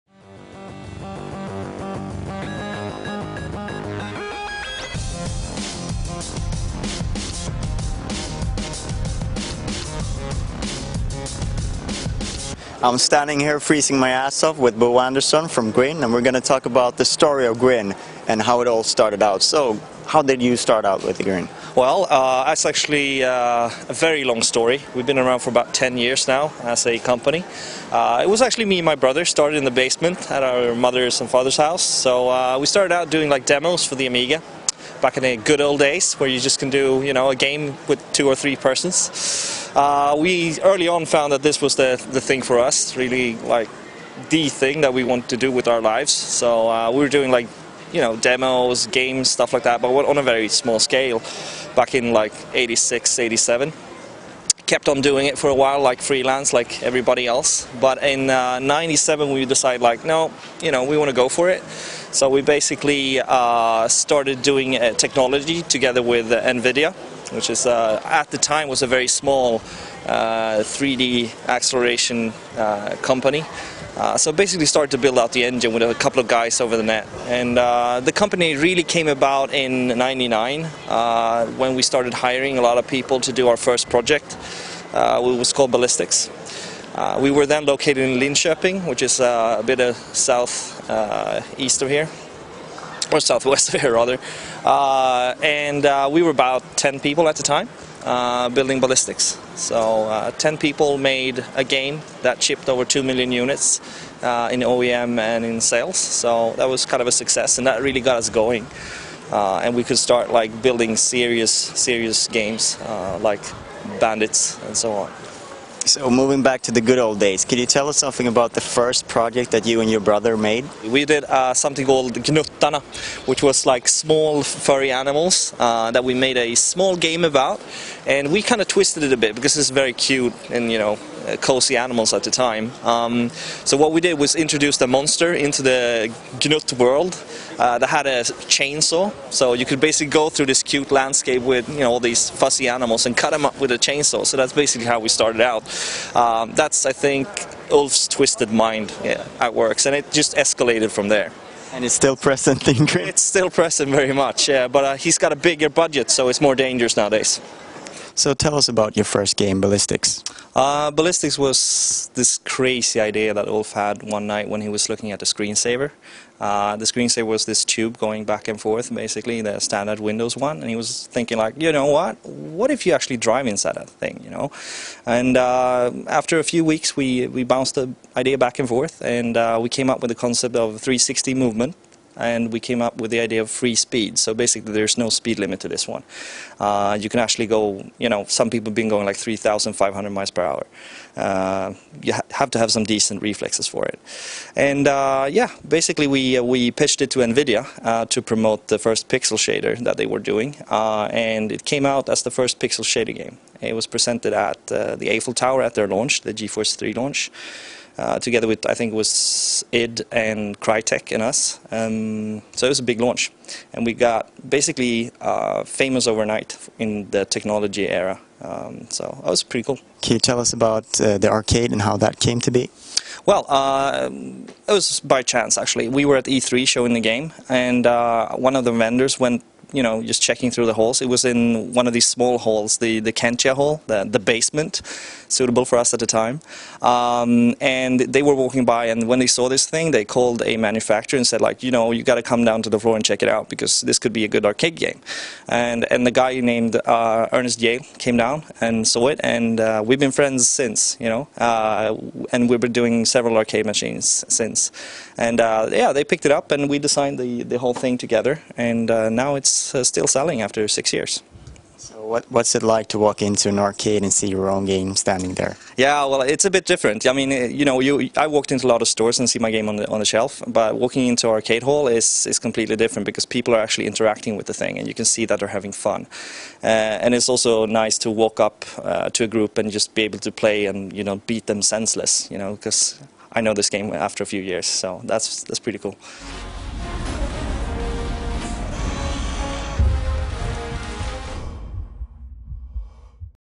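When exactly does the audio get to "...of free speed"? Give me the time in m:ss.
3:03.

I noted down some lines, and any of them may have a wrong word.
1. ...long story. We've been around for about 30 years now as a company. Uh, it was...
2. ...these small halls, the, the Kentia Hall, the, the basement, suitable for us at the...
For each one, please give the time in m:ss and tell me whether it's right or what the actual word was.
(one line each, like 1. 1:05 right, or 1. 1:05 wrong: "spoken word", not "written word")
1. 0:24 wrong: "10", not "30"
2. 3:51 right.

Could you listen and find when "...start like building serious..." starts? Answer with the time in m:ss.
1:49.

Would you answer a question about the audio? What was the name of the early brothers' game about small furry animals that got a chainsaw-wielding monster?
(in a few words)
Gnuttana.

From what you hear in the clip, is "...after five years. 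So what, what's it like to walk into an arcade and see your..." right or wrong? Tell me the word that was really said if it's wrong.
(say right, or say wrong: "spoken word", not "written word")
wrong: "six", not "five".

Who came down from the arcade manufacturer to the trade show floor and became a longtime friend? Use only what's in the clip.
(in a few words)
Ernest Yale.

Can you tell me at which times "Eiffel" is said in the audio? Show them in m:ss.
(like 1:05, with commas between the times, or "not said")
3:25.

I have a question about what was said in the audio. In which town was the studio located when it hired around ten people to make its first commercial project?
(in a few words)
Linköping.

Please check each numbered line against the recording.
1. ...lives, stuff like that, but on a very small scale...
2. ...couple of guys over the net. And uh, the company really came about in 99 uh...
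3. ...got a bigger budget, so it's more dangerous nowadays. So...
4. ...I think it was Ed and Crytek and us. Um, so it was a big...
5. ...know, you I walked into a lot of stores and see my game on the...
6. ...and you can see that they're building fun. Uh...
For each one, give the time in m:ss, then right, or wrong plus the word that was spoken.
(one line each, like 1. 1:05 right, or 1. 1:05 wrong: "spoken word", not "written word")
1. 0:48 wrong: "games", not "lives"
2. 1:15 right
3. 2:35 right
4. 3:28 right
5. 4:27 right
6. 4:34 wrong: "having", not "building".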